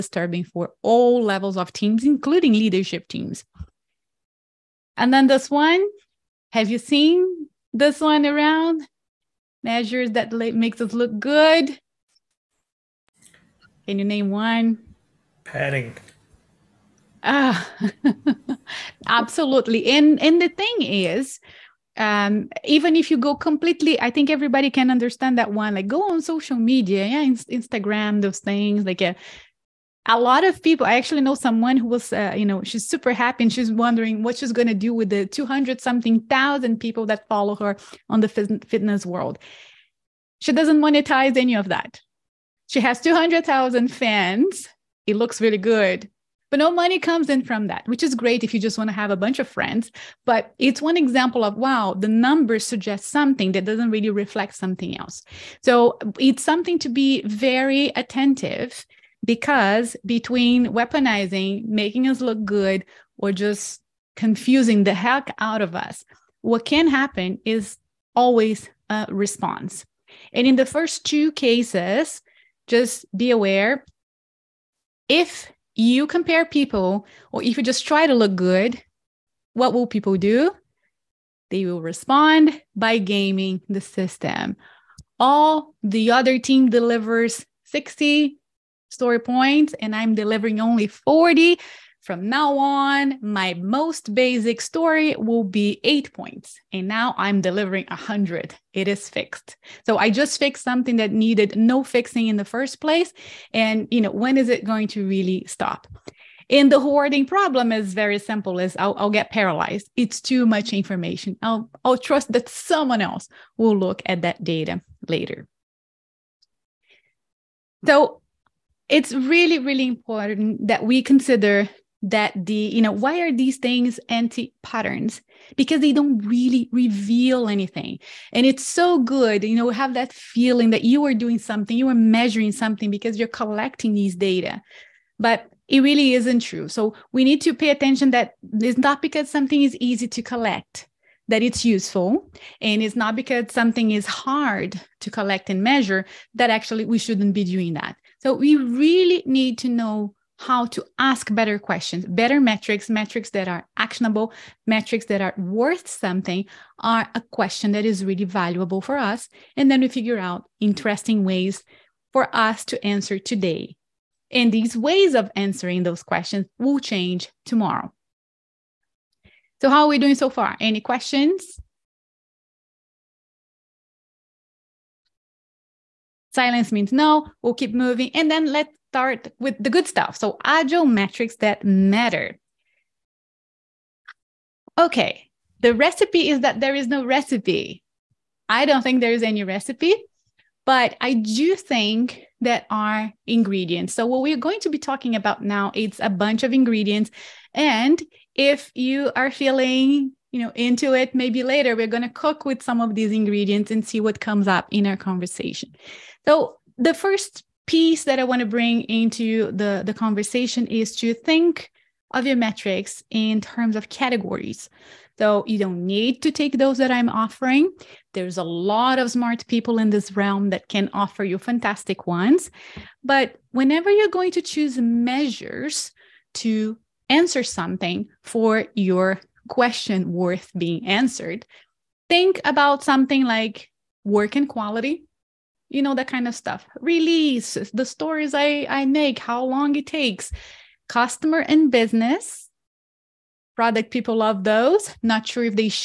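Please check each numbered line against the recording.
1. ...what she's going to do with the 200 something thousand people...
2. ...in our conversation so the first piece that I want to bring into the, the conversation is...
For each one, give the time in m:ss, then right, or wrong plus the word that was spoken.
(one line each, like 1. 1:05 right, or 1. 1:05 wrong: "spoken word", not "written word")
1. 0:34 right
2. 3:24 right.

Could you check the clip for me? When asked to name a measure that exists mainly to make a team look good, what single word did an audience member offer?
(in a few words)
Padding.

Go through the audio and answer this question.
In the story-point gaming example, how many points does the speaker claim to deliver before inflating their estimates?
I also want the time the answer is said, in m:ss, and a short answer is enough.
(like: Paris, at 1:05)
40, at 1:30.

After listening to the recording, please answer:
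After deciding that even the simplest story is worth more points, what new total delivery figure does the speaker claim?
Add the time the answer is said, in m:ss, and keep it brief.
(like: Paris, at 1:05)
100, at 1:37.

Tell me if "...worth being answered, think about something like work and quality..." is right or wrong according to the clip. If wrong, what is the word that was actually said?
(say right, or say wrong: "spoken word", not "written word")
right.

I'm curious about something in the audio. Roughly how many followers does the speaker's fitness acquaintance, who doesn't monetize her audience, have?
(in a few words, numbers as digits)
200,000.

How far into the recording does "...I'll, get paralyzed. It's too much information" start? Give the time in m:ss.
1:48.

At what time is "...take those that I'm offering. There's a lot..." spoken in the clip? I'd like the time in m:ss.
3:36.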